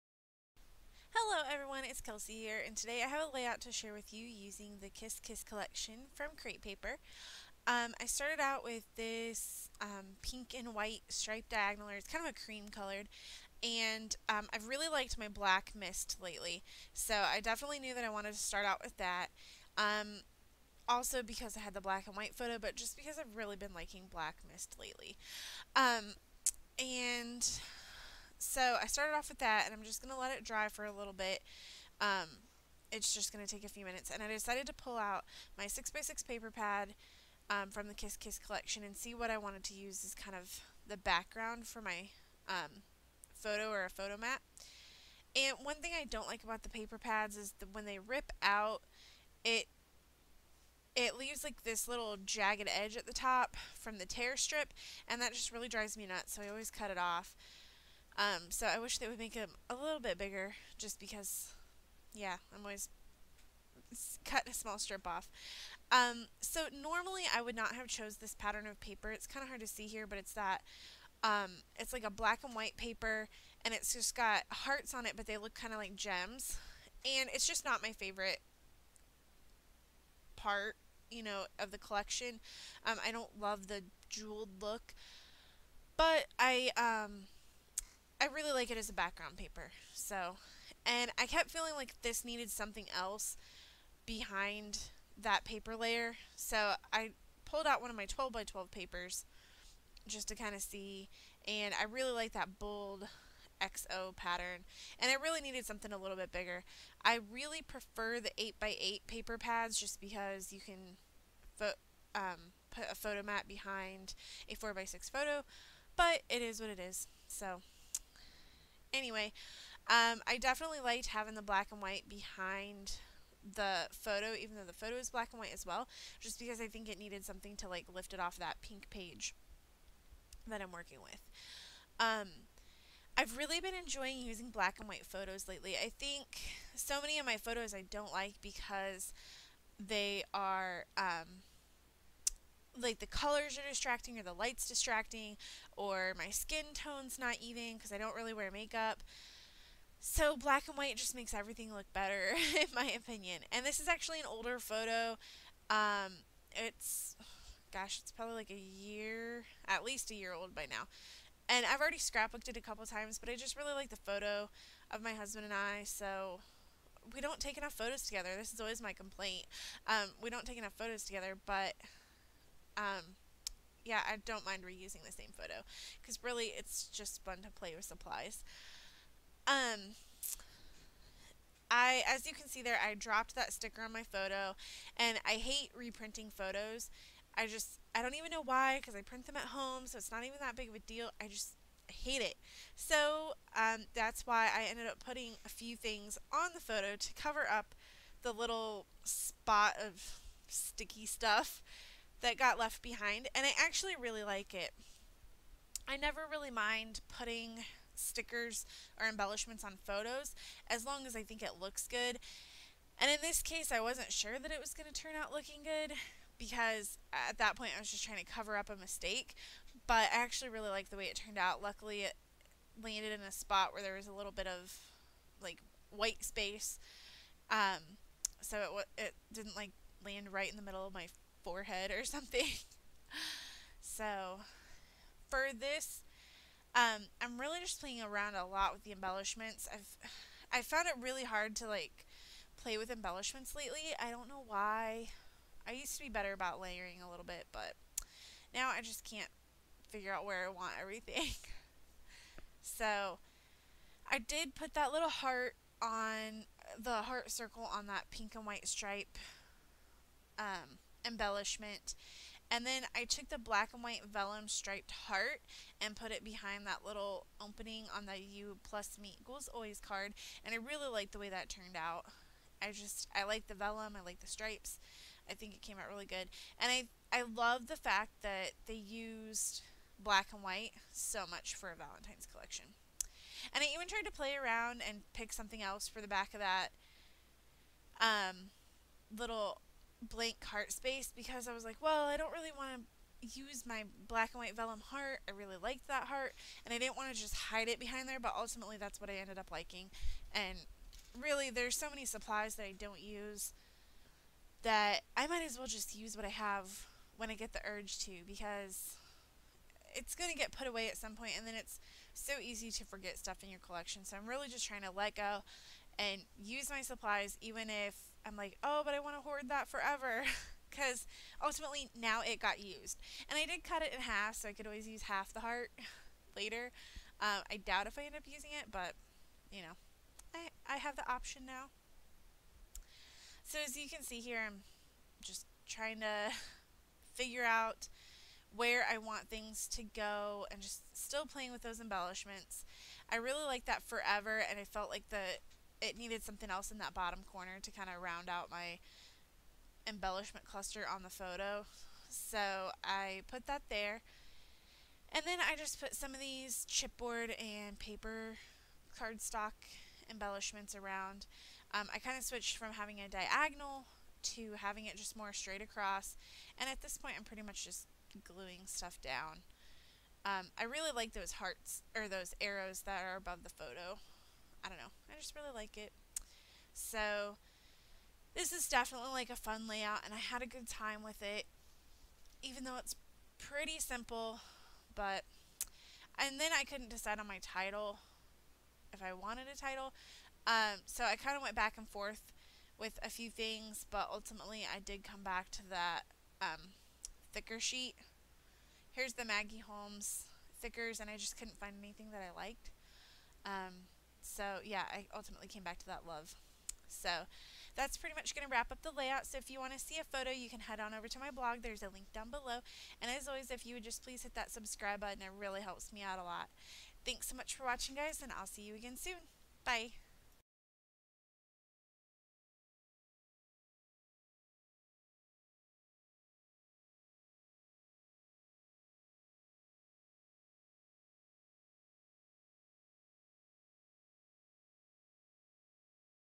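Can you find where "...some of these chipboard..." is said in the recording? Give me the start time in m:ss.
5:55.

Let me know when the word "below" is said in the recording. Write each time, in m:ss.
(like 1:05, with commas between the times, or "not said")
6:52.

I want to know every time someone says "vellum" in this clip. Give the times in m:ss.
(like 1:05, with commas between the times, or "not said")
4:24, 4:33, 4:54.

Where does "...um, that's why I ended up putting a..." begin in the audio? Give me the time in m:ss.
3:13.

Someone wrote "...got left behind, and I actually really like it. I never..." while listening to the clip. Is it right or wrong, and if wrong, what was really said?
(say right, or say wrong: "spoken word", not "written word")
right.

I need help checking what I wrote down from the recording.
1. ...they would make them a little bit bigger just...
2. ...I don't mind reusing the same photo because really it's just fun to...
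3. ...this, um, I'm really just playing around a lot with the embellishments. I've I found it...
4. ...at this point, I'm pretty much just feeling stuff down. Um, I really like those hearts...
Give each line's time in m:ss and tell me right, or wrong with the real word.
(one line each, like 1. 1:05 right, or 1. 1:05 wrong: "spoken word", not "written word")
1. 0:58 right
2. 2:54 right
3. 3:55 right
4. 6:06 wrong: "gluing", not "feeling".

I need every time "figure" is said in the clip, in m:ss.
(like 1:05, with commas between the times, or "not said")
4:09, 5:37.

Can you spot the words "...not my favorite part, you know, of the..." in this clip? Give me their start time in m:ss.
1:17.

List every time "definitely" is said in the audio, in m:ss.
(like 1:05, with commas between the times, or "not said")
0:17, 2:00, 6:18.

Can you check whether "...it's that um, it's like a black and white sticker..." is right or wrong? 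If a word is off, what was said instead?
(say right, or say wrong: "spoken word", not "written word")
wrong: "paper", not "sticker".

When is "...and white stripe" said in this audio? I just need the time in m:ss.
4:18.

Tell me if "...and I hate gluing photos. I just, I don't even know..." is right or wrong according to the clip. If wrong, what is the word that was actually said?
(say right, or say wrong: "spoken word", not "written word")
wrong: "reprinting", not "gluing".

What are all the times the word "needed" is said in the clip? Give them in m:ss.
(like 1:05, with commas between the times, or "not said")
1:32, 1:45, 2:06, 5:45.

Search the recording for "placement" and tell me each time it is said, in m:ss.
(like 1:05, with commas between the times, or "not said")
not said.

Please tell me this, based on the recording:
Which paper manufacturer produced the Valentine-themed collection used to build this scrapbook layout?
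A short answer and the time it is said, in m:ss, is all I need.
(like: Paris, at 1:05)
Crate Paper, at 0:06.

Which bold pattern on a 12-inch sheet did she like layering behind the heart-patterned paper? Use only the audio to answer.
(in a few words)
XO.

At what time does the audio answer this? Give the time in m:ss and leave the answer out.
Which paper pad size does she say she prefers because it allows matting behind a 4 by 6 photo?
1:48.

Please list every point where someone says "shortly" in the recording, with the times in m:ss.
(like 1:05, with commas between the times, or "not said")
not said.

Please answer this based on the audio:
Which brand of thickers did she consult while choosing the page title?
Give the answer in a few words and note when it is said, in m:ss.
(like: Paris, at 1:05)
Maggie Holmes, at 6:39.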